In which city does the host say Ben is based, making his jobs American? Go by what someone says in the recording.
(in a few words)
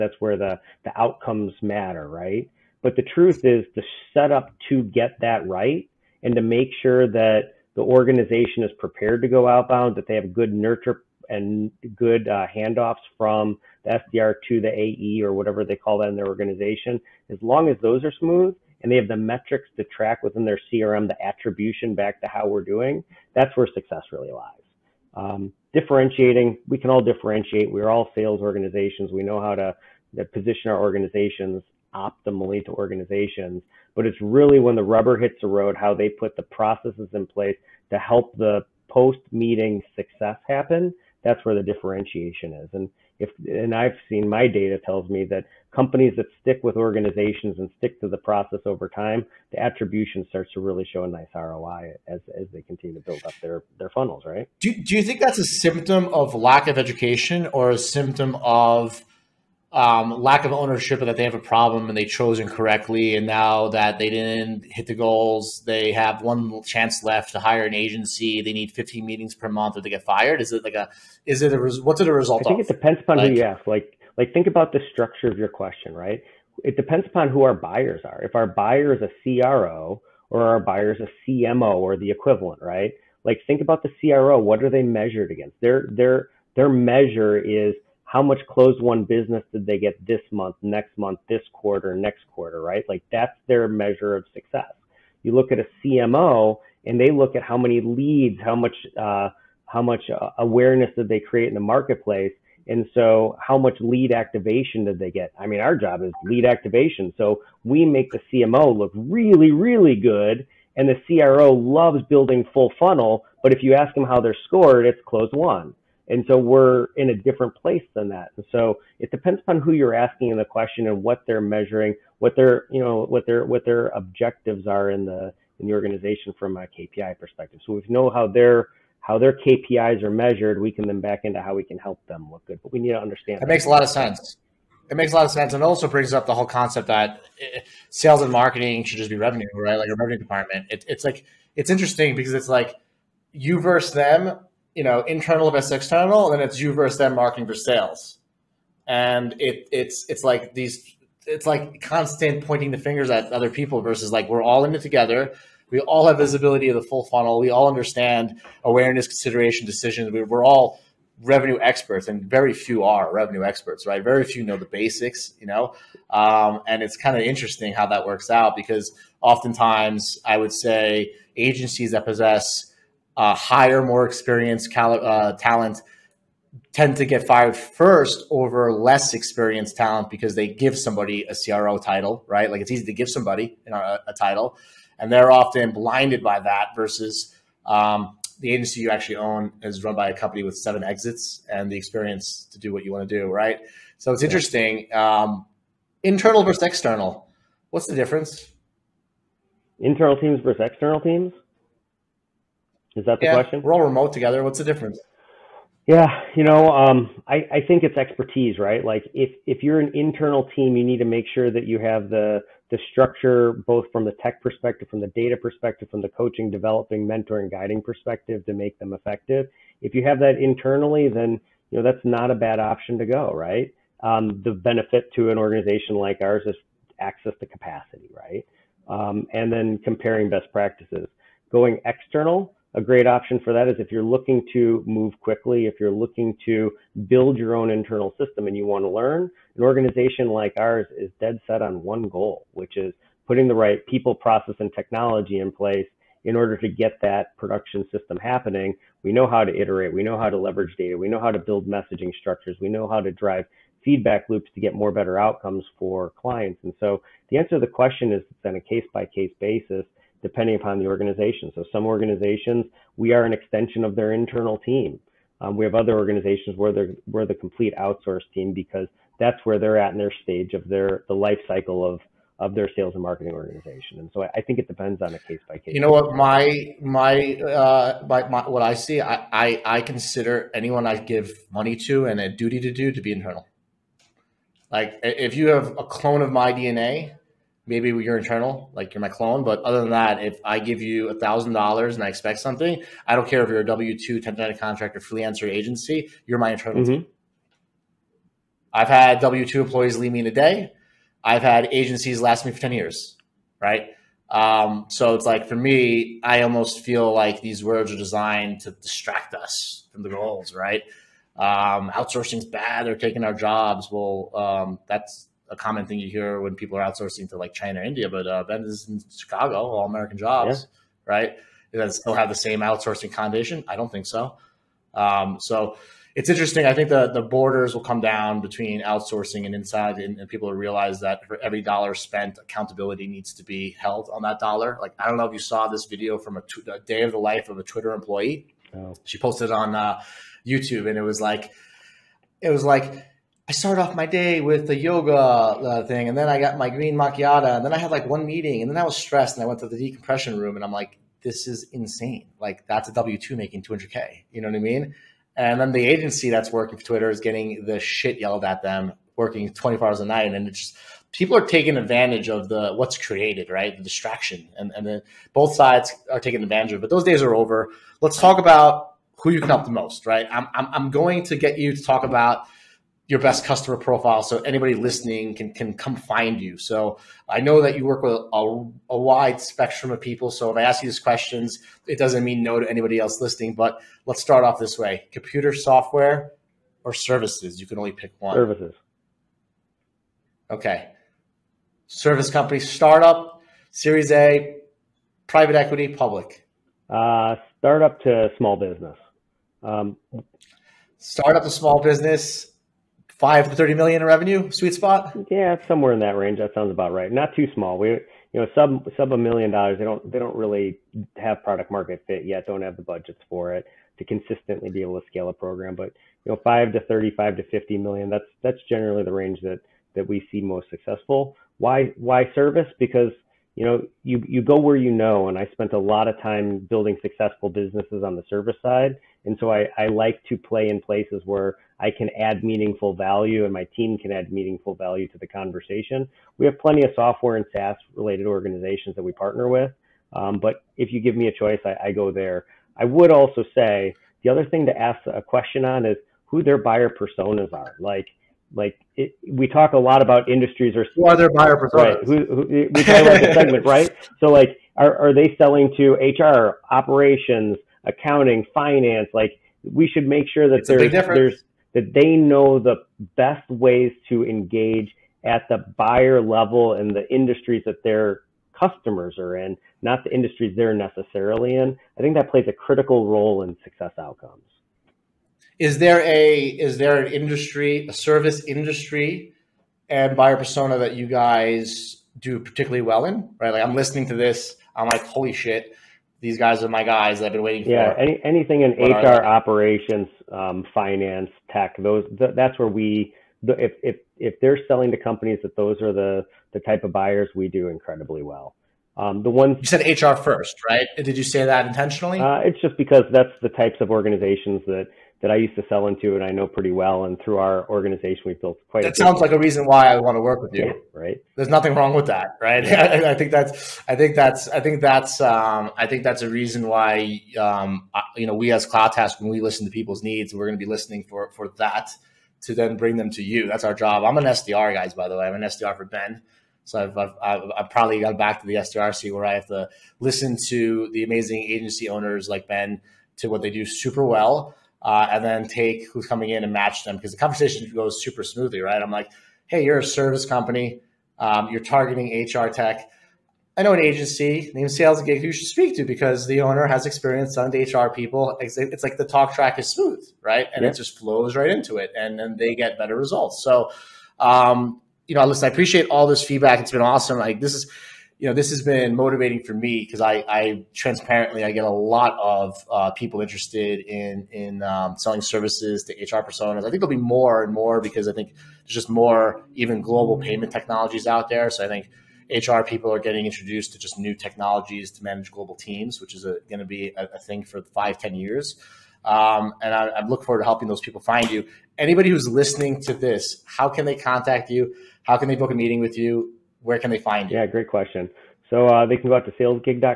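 Chicago.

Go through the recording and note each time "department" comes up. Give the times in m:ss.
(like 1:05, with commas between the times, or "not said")
2:20.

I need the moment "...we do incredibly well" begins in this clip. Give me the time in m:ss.
8:17.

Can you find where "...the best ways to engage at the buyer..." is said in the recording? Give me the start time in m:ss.
7:42.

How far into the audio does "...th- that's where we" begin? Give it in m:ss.
8:12.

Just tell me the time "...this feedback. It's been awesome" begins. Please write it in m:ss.
9:16.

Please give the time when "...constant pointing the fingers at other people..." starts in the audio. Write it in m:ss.
2:31.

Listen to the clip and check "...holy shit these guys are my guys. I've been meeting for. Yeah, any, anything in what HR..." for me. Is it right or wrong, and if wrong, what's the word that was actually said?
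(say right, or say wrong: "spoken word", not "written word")
wrong: "waiting", not "meeting".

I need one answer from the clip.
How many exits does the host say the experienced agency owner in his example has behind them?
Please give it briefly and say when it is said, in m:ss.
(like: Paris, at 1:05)
Seven, at 3:10.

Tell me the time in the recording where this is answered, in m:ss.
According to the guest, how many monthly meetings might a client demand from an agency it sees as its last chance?
1:08.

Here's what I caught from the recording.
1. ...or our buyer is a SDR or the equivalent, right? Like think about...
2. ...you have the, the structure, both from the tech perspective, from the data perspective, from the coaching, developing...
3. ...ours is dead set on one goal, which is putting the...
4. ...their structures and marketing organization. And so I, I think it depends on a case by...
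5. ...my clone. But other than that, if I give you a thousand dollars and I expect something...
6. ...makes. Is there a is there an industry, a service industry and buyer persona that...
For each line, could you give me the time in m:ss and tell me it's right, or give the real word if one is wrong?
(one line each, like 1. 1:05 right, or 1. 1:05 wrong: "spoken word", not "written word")
1. 1:20 wrong: "CMO", not "SDR"
2. 3:31 right
3. 4:00 right
4. 4:32 wrong: "sales", not "structures"
5. 4:49 right
6. 7:53 wrong: "outcomes", not "makes".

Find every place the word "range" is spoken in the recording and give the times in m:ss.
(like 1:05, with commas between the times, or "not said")
6:46, 6:59.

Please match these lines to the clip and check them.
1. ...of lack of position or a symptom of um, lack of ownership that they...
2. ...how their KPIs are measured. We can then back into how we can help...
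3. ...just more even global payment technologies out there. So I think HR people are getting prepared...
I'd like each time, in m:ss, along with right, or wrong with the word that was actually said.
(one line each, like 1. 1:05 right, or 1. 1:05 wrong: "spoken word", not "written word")
1. 0:56 wrong: "education", not "position"
2. 2:09 right
3. 9:28 wrong: "introduced", not "prepared".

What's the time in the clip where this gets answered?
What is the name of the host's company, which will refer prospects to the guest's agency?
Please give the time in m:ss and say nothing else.
8:38.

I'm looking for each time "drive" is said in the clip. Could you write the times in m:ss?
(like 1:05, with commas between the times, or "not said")
4:13.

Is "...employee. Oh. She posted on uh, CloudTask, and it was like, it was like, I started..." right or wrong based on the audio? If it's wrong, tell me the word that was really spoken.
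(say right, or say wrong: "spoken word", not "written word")
wrong: "YouTube", not "CloudTask".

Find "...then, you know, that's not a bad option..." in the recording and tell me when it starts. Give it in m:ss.
3:41.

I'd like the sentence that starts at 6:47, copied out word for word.
We you know sub sub a million dollars.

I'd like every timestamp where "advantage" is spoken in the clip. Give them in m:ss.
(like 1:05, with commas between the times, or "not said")
6:01, 6:06.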